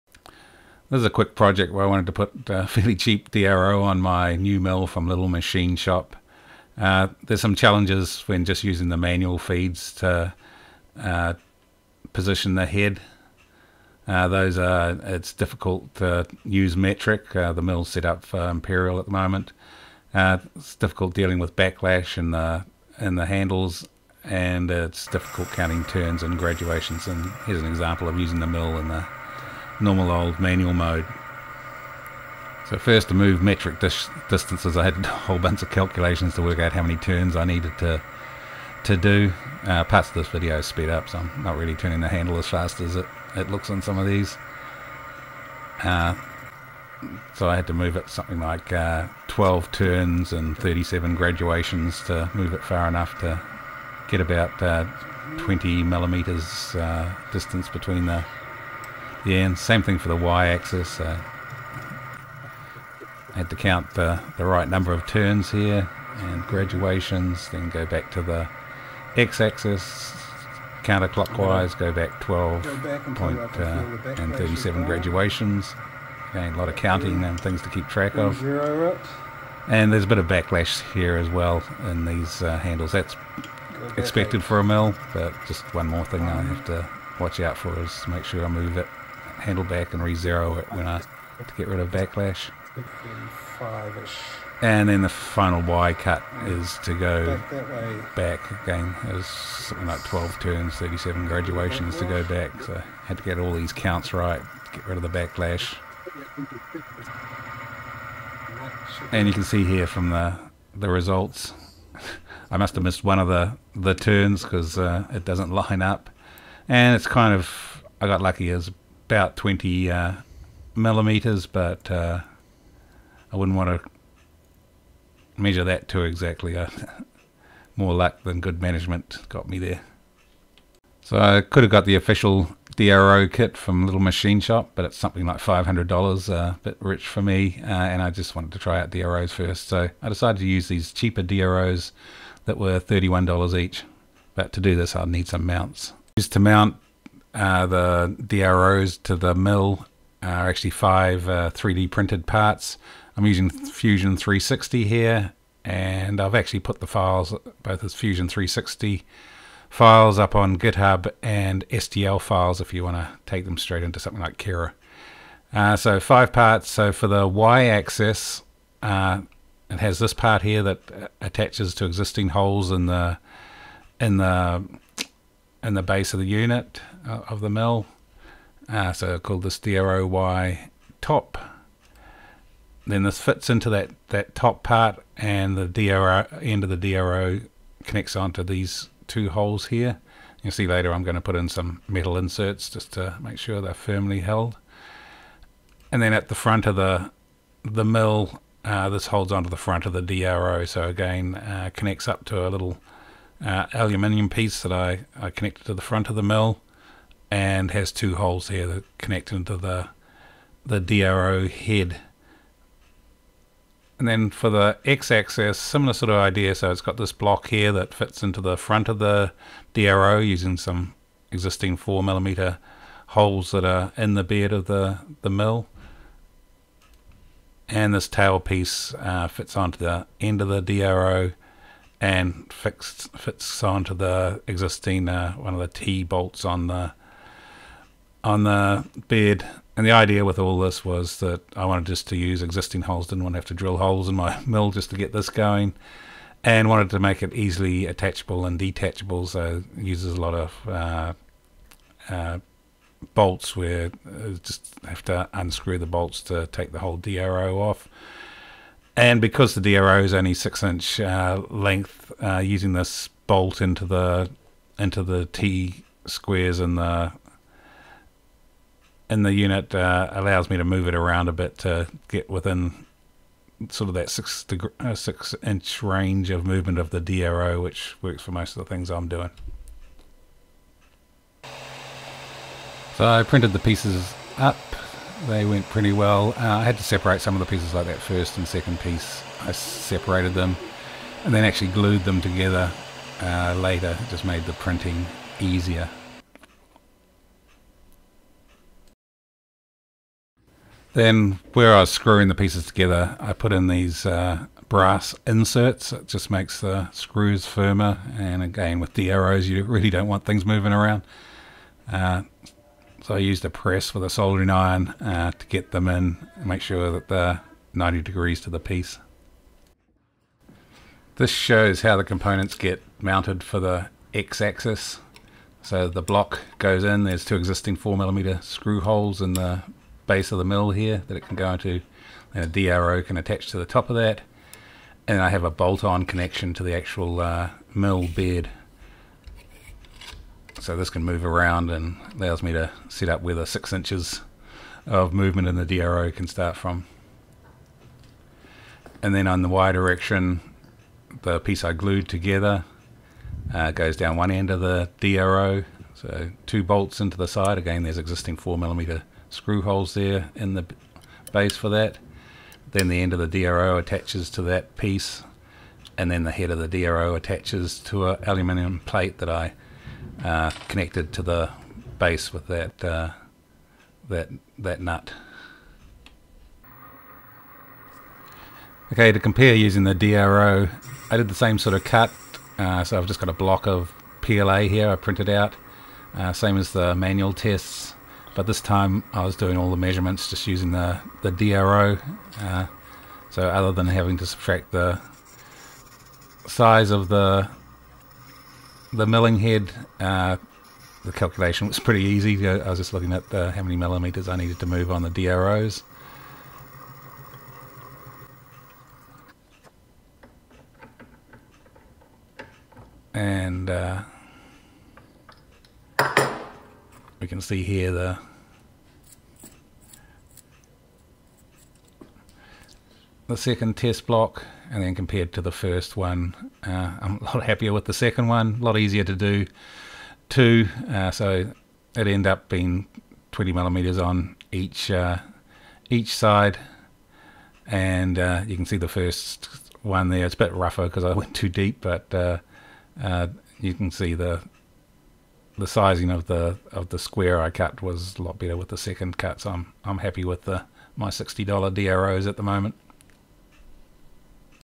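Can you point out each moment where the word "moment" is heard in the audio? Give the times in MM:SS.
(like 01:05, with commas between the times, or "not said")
00:19, 07:32.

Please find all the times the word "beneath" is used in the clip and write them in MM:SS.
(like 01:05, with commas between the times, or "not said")
not said.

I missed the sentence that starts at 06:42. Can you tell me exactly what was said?
I was just looking at the, uh, how many millimeters I needed to move on the DROs.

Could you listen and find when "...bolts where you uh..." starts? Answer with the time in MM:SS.
04:13.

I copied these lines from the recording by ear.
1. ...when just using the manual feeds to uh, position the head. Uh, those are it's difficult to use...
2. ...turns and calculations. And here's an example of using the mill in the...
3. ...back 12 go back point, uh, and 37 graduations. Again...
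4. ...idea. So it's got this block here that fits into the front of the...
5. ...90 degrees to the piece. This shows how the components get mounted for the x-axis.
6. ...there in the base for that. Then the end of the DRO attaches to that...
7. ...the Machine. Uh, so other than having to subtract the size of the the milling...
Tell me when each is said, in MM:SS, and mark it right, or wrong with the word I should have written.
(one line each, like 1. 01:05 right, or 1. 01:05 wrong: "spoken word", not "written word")
1. 00:08 right
2. 00:25 wrong: "graduations", not "calculations"
3. 01:11 right
4. 03:36 right
5. 05:17 right
6. 05:59 right
7. 06:31 wrong: "DRO", not "Machine".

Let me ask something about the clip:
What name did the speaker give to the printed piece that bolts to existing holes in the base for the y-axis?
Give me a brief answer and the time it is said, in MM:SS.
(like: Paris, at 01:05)
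DROY top, at 02:59.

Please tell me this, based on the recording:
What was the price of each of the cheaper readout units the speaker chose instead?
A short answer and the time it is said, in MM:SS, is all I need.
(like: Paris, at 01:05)
$31, at 02:22.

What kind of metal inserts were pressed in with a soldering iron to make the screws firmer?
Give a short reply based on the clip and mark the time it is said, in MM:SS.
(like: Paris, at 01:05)
brass inserts, at 05:04.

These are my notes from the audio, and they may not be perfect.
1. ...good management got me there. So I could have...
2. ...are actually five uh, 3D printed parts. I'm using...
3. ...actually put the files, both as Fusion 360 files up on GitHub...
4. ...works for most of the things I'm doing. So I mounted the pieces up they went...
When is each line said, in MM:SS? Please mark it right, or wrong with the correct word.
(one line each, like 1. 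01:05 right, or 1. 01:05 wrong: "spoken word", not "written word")
1. 02:08 right
2. 02:30 right
3. 02:36 right
4. 04:38 wrong: "printed", not "mounted".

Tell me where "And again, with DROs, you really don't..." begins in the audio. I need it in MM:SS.
05:08.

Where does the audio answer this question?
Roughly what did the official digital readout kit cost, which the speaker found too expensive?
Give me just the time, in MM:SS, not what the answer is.
02:15.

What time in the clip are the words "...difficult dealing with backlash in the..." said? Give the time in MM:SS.
00:20.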